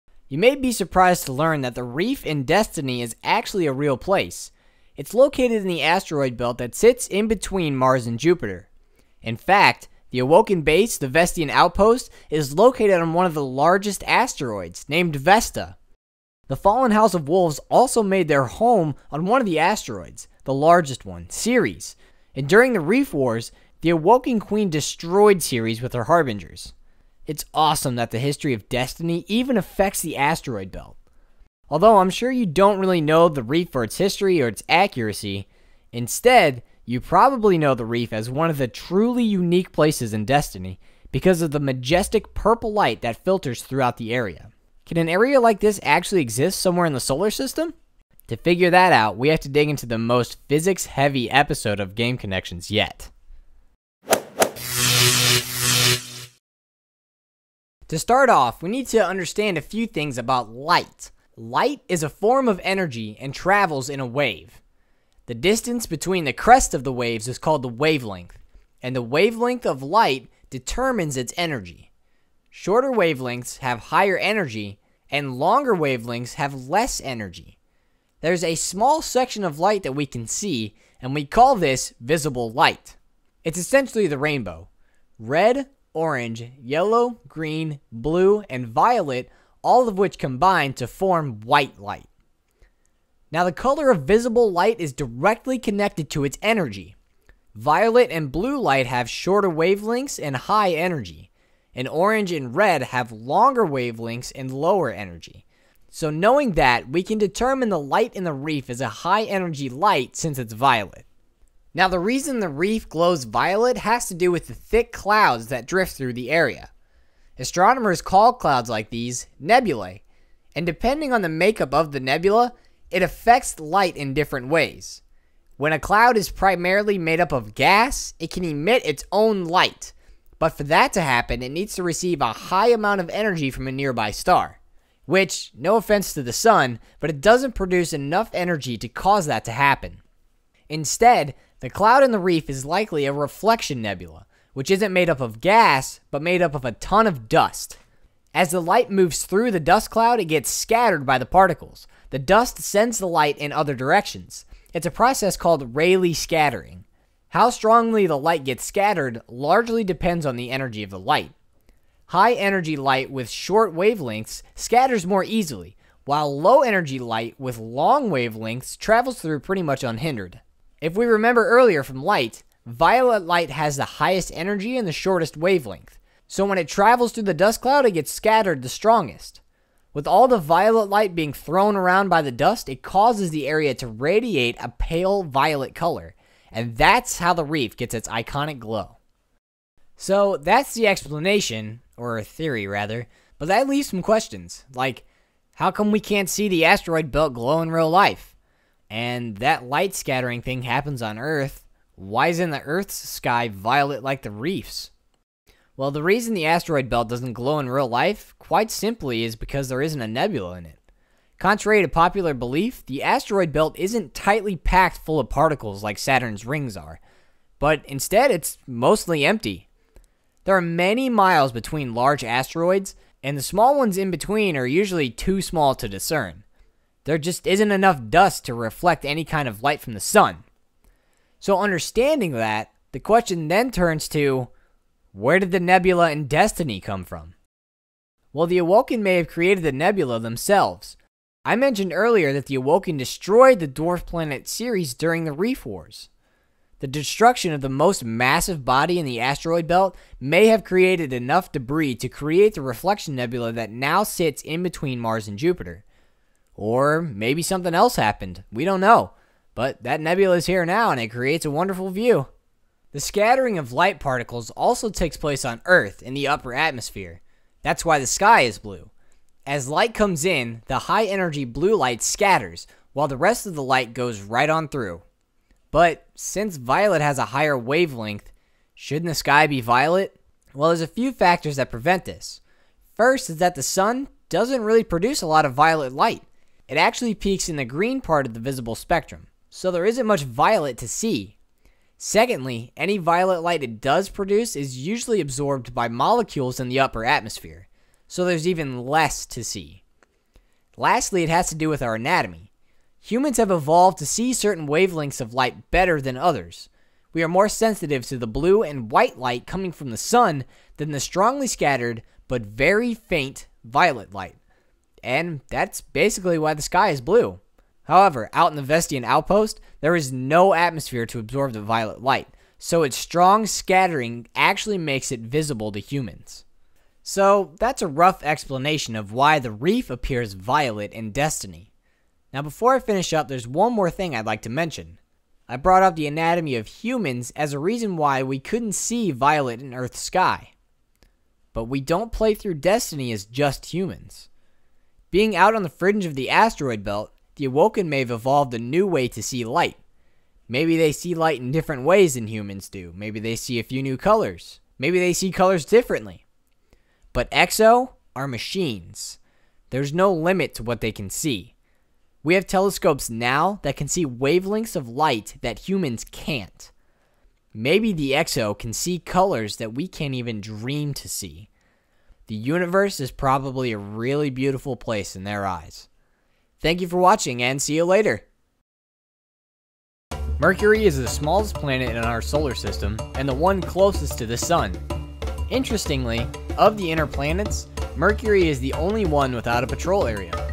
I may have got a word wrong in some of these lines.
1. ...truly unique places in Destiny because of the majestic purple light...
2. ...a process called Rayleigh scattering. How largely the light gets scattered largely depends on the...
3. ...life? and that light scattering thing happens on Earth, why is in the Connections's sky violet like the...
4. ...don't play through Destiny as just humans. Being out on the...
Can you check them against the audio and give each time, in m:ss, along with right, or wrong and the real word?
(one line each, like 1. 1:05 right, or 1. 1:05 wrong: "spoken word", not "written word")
1. 0:38 right
2. 2:34 wrong: "strongly", not "largely"
3. 3:17 wrong: "Earth", not "Connections"
4. 5:41 right.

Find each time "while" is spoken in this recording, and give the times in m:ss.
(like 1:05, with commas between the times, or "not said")
2:46, 4:32.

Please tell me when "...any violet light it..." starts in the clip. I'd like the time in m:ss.
4:52.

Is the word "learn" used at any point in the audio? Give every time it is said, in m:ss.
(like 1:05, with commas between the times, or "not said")
0:01.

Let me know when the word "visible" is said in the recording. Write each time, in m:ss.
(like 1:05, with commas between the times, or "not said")
1:21, 1:34, 4:48, 5:25.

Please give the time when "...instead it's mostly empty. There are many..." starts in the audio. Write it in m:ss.
3:37.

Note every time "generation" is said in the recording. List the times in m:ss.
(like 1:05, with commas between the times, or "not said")
not said.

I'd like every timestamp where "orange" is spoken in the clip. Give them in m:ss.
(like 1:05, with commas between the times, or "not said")
1:25, 1:41.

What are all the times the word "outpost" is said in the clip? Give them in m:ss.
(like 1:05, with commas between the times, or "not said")
0:11, 5:19.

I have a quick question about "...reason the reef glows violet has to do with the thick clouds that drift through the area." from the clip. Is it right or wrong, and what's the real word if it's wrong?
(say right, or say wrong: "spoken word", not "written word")
right.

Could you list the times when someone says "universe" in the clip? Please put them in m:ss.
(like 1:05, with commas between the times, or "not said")
6:12.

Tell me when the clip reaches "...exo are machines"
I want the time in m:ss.
5:57.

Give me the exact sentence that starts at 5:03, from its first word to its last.
Humans have evolved to see certain wavelengths of light better than others.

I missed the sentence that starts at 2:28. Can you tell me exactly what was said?
As the light moves through the dust cloud, it gets scattered by the particles.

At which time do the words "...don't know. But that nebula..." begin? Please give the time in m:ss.
4:18.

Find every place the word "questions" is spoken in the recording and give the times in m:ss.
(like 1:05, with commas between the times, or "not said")
3:14, 3:52.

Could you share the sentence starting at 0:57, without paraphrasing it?
To start off, we need to understand a few things about light.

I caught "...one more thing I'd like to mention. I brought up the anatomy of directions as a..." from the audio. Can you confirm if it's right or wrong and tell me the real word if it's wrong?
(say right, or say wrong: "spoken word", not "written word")
wrong: "humans", not "directions".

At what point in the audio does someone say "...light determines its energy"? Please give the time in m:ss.
1:09.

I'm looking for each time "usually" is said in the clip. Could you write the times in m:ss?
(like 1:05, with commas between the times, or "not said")
3:44, 4:54.